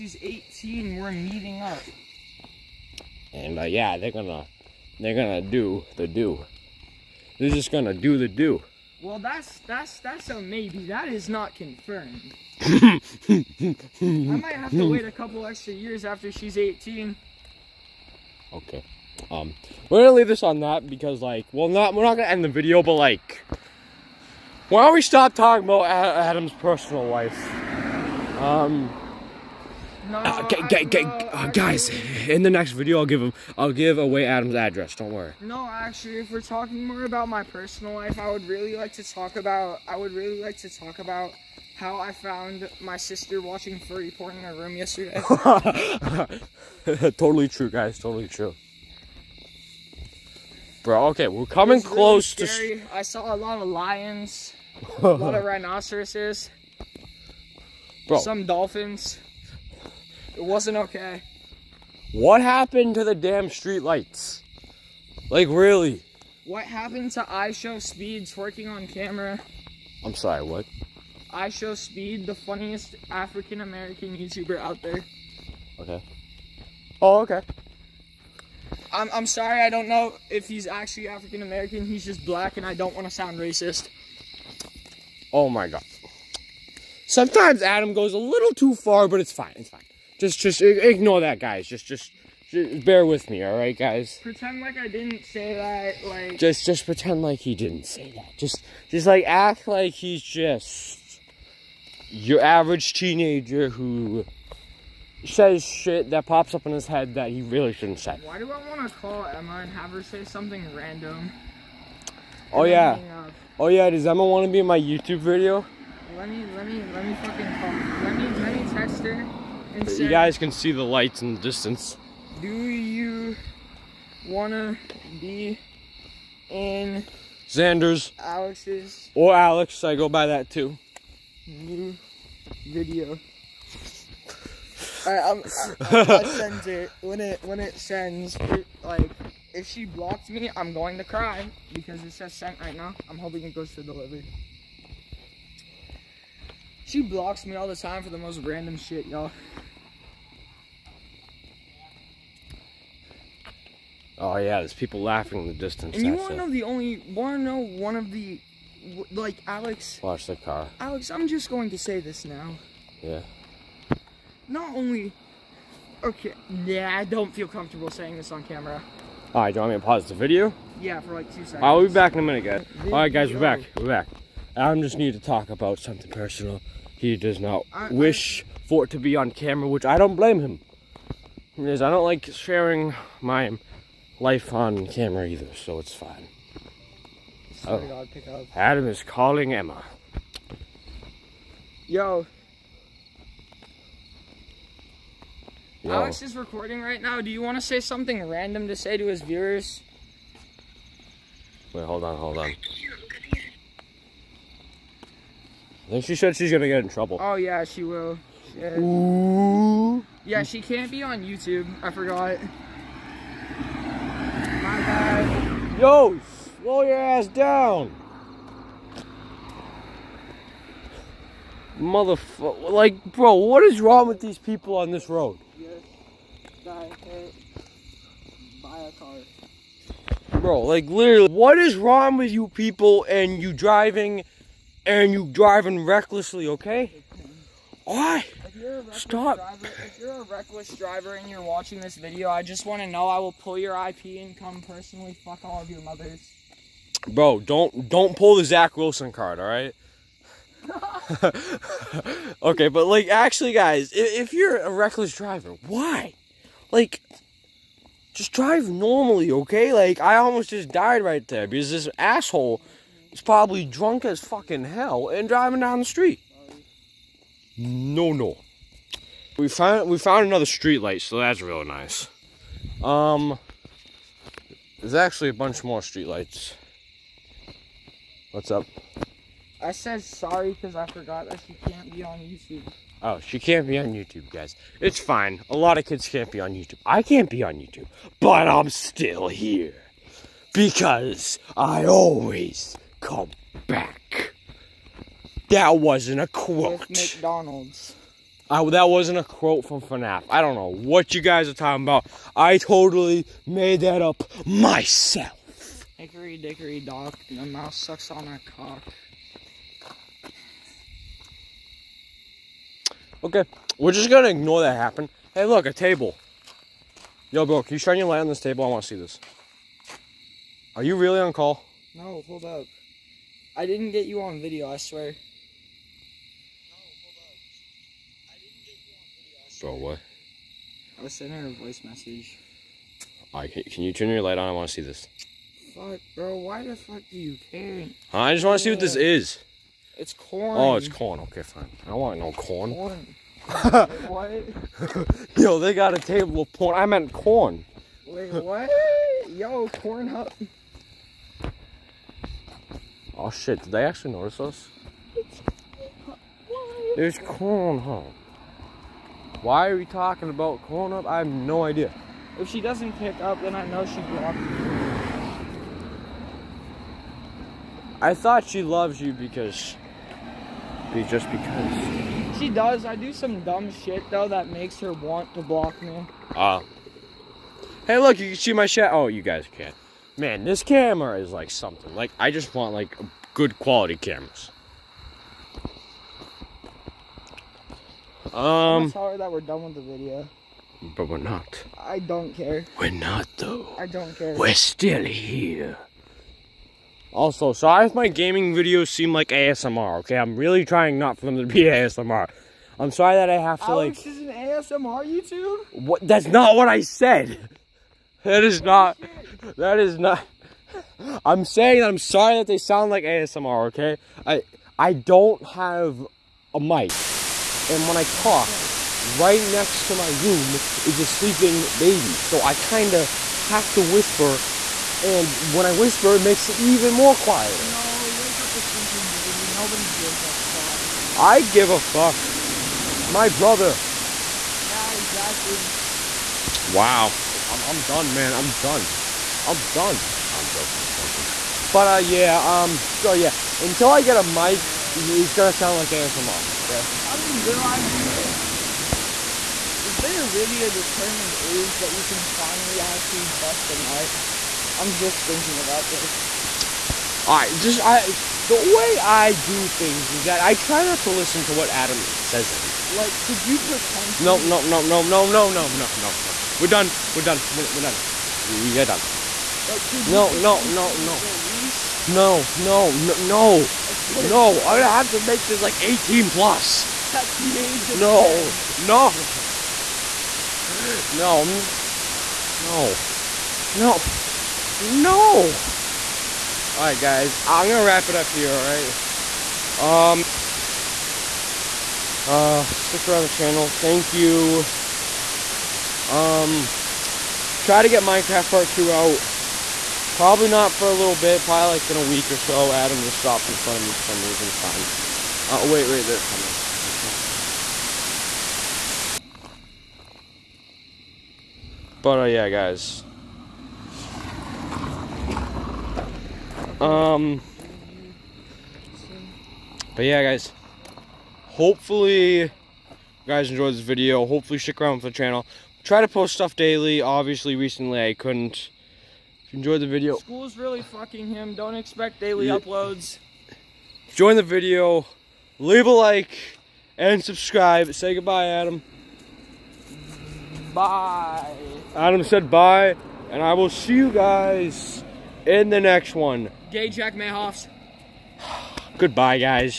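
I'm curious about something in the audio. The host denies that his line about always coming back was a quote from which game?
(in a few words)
FNAF.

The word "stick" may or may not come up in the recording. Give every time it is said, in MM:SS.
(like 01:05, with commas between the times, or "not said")
08:12, 08:44.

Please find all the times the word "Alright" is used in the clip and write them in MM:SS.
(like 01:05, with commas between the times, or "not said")
02:15, 07:37.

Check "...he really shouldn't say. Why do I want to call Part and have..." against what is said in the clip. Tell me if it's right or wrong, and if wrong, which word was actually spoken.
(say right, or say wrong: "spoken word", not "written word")
wrong: "Emma", not "Part".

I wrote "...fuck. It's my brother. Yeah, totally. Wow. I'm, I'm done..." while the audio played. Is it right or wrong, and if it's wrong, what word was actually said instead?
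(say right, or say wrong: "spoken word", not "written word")
wrong: "exactly", not "totally".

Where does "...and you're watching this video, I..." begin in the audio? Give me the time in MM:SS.
04:01.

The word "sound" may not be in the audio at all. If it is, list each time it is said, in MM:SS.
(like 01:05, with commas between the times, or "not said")
01:23, 06:52, 07:25.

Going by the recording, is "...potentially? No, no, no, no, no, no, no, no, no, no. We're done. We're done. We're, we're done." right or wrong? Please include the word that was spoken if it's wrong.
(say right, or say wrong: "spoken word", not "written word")
right.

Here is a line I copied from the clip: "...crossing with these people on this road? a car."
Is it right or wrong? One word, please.
wrong.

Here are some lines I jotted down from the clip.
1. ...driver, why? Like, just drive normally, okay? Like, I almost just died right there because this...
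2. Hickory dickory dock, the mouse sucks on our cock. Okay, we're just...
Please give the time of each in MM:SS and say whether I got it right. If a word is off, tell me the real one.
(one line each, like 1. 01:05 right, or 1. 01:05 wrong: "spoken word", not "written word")
1. 04:15 right
2. 05:05 right.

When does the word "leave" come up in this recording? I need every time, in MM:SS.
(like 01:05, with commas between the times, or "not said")
00:20, 08:55.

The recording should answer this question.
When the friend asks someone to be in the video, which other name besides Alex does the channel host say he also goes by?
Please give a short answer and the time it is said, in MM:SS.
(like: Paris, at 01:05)
Xander, at 02:07.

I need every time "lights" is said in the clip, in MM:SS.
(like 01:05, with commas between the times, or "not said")
01:03, 02:00, 04:30, 04:36, 05:18, 05:34.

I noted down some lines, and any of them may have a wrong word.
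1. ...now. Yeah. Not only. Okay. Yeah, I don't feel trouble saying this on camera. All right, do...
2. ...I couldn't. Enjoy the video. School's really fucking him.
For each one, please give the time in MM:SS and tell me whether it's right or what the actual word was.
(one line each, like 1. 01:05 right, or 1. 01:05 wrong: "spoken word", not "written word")
1. 02:42 wrong: "comfortable", not "trouble"
2. 08:48 right.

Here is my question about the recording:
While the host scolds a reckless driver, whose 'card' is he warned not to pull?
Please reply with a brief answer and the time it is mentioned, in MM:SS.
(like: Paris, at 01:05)
Zach Wilson, at 04:08.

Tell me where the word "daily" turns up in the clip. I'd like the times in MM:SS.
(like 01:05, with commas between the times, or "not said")
08:46, 08:52.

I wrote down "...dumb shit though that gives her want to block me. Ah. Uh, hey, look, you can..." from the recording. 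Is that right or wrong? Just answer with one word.
wrong.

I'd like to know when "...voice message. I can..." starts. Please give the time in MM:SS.
05:31.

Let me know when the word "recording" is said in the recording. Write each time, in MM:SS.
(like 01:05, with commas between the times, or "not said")
03:16.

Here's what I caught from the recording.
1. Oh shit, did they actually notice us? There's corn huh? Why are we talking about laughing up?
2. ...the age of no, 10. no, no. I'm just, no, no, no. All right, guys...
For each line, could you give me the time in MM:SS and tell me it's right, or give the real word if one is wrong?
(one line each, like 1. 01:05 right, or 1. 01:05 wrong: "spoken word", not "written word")
1. 05:53 wrong: "calling", not "laughing"
2. 07:57 right.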